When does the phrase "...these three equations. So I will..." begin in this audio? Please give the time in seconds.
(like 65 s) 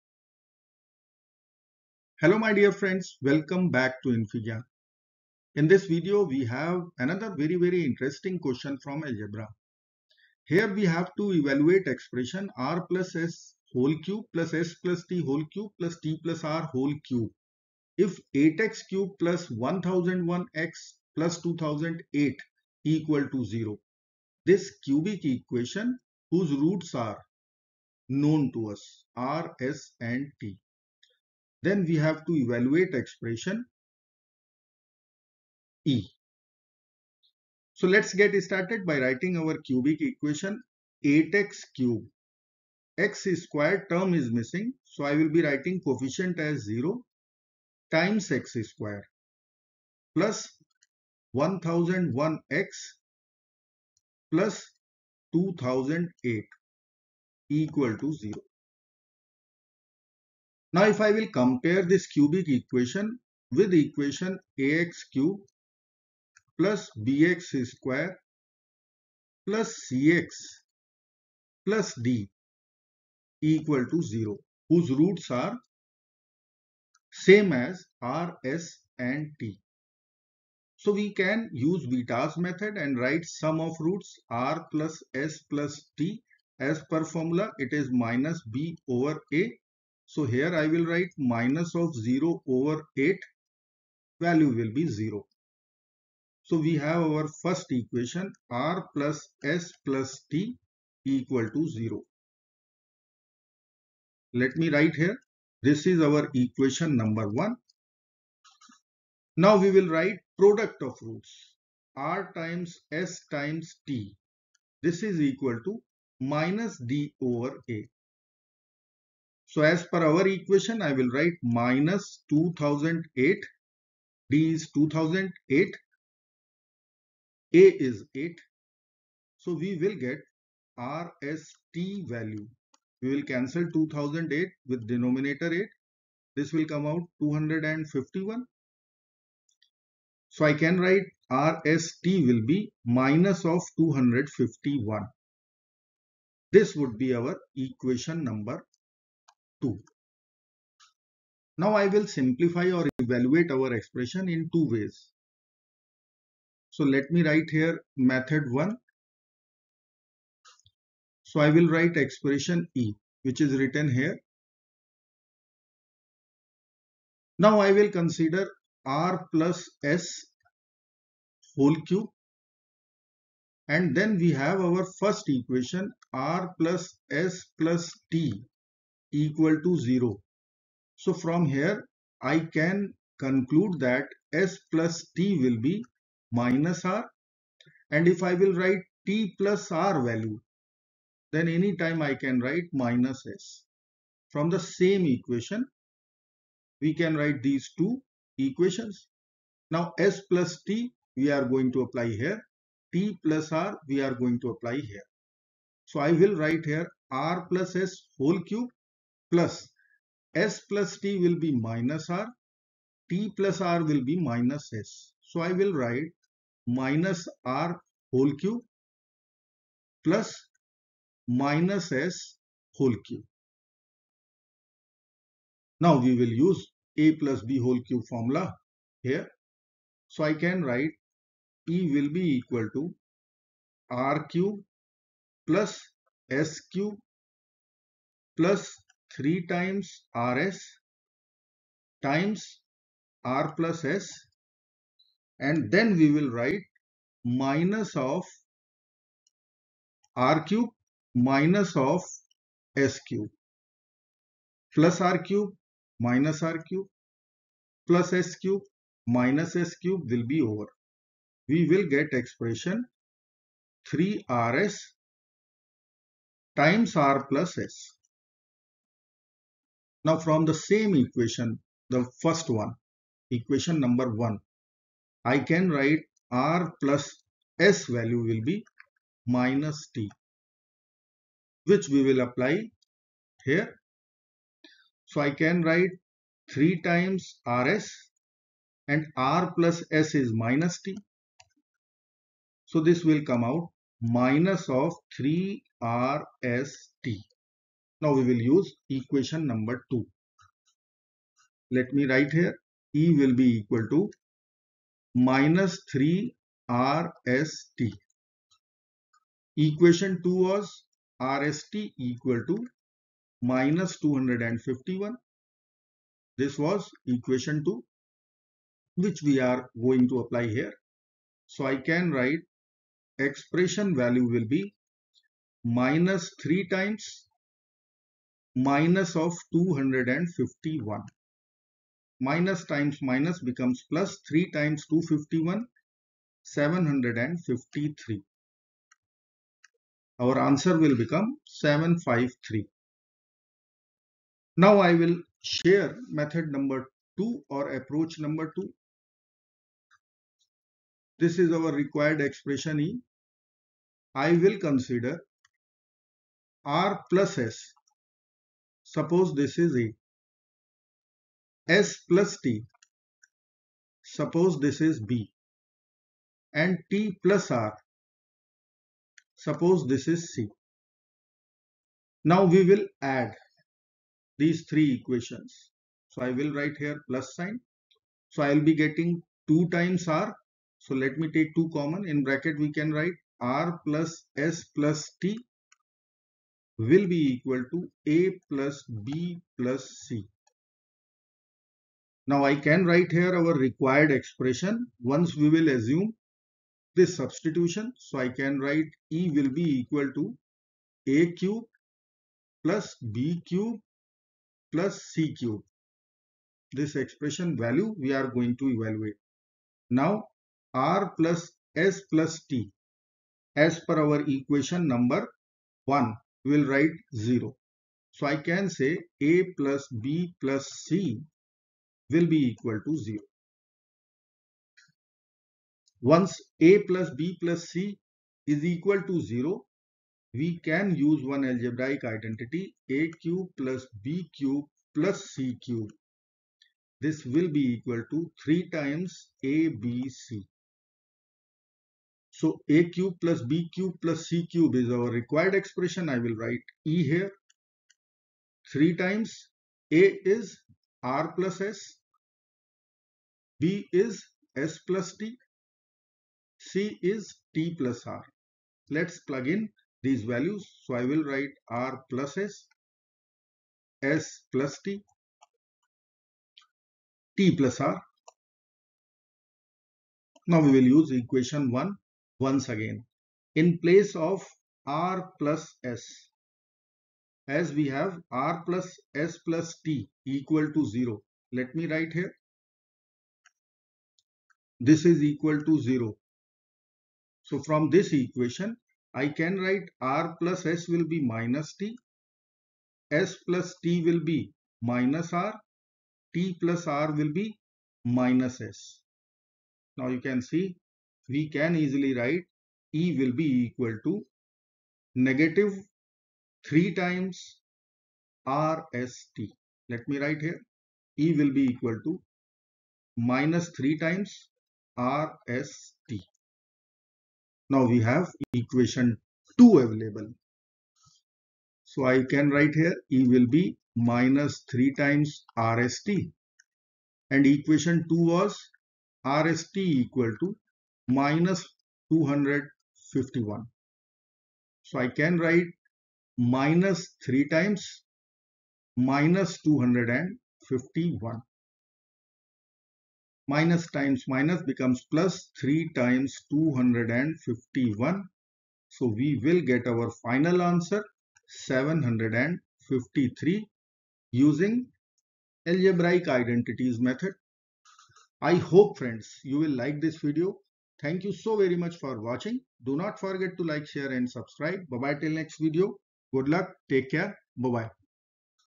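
374 s.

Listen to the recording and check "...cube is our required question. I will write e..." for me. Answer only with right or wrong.
wrong.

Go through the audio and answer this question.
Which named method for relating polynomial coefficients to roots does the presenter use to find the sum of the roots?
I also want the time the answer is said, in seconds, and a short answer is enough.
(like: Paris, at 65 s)
Vieta's method, at 81 s.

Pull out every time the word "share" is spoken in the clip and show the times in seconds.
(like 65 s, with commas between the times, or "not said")
345 s, 563 s.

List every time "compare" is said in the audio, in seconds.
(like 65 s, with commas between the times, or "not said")
61 s.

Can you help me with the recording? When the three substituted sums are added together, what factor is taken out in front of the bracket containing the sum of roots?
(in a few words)
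2.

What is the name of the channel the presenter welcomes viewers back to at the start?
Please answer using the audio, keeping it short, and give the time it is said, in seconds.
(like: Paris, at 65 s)
infyGyan, at 4 s.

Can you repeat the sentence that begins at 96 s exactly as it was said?
So we have our first equation r plus s plus t equal to 0.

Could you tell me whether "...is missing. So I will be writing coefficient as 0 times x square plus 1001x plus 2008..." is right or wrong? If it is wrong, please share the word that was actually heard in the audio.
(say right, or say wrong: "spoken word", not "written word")
right.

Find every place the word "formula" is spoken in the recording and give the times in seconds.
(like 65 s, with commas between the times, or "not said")
87 s, 228 s.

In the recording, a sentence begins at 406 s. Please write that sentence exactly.
This expression value we are going to evaluate.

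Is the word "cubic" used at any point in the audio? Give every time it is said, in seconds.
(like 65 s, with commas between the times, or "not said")
24 s, 39 s, 62 s.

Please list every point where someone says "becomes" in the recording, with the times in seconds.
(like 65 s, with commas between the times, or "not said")
333 s, 340 s, 544 s.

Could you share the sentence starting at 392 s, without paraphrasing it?
Now I can write here our required expression once we will assume this substitution.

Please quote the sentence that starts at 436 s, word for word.
This will be equal to 3 times a b c.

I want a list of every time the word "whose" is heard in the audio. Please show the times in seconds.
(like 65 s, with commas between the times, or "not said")
26 s, 74 s.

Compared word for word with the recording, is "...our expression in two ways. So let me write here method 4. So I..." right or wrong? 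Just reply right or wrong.
wrong.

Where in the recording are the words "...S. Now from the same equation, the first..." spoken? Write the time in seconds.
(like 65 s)
267 s.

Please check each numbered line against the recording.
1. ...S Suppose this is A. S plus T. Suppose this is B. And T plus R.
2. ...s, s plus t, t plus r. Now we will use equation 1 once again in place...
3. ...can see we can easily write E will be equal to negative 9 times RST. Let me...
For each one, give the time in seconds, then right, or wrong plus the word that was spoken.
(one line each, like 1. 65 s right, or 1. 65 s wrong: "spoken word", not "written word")
1. 357 s right
2. 462 s right
3. 500 s wrong: "3", not "9".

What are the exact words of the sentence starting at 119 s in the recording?
So as per our equation, I will write minus 2008.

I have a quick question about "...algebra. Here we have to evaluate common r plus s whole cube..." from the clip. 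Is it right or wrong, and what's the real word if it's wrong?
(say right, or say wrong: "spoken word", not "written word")
wrong: "expression", not "common".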